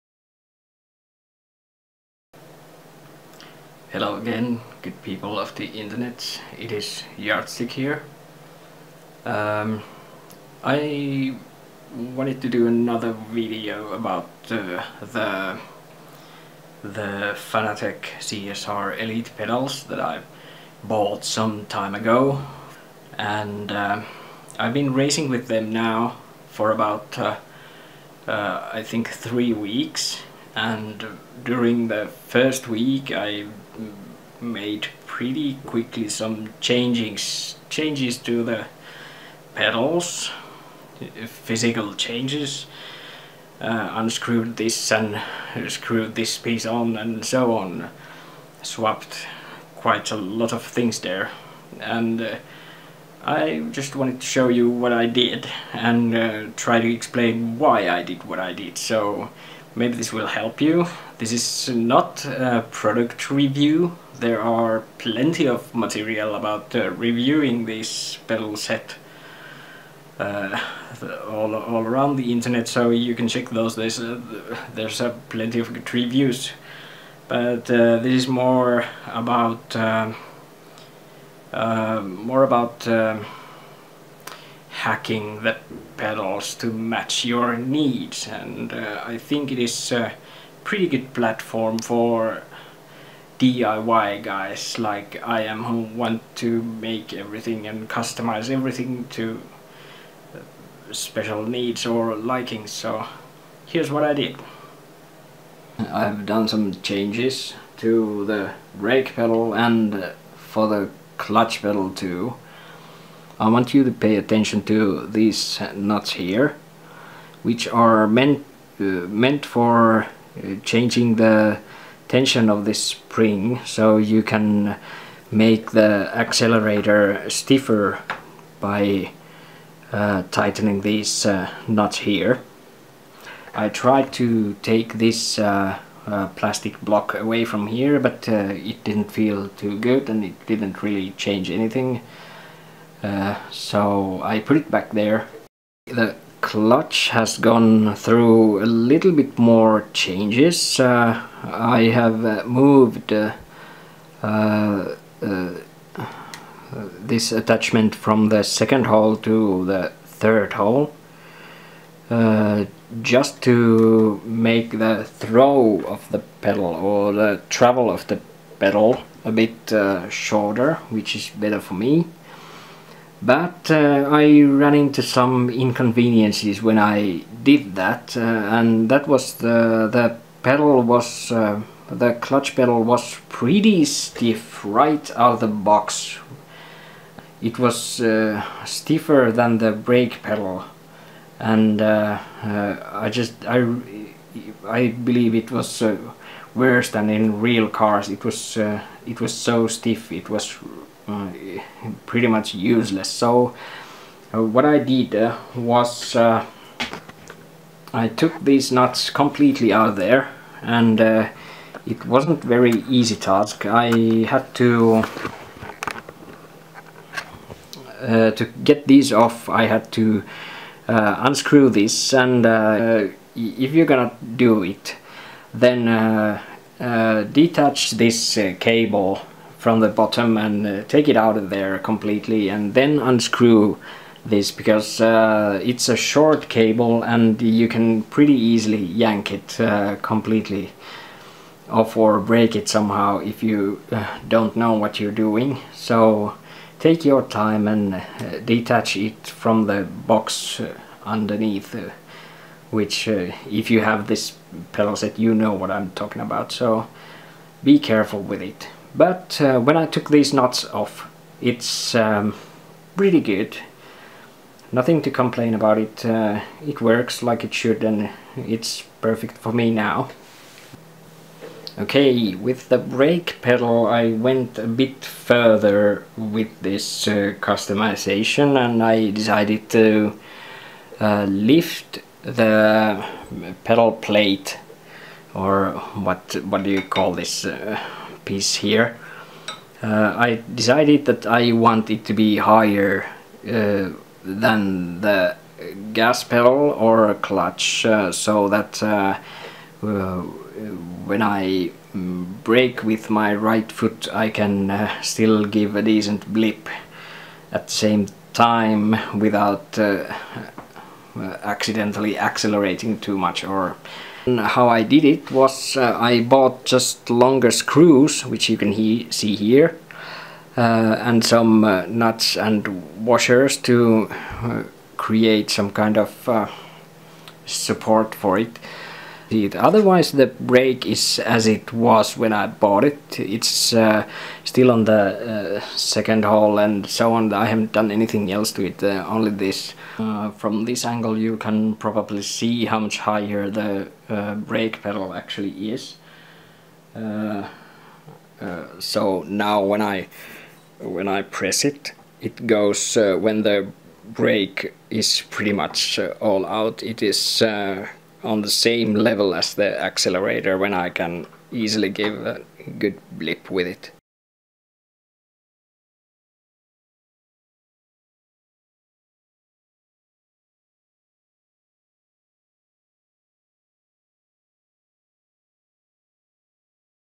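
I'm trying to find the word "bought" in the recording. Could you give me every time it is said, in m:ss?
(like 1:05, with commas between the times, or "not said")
0:20, 5:16, 5:32.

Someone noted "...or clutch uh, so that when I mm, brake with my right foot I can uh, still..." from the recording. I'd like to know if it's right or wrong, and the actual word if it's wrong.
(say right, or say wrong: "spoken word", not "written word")
right.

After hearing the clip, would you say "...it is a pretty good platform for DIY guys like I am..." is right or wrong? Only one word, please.
right.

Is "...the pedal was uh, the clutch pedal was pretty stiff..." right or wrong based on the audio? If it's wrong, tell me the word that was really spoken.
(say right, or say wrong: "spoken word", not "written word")
right.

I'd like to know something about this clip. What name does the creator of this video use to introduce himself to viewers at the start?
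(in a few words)
Yardstick.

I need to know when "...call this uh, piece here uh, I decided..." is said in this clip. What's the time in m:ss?
4:46.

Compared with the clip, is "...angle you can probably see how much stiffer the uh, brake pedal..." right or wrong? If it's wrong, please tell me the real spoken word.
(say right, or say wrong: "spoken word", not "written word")
wrong: "higher", not "stiffer".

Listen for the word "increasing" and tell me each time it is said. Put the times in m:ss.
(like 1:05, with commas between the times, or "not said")
not said.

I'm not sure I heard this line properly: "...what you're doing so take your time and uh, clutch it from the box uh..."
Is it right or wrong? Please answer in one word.
wrong.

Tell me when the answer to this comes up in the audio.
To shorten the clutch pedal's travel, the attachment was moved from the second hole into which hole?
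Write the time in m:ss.
2:40.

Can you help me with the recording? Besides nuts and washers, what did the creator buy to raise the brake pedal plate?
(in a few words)
longer screws.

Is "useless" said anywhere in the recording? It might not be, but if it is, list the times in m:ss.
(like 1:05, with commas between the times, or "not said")
3:22.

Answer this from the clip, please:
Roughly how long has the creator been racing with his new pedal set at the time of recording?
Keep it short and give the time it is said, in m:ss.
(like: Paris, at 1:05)
3 weeks, at 0:29.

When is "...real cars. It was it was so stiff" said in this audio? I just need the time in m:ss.
3:17.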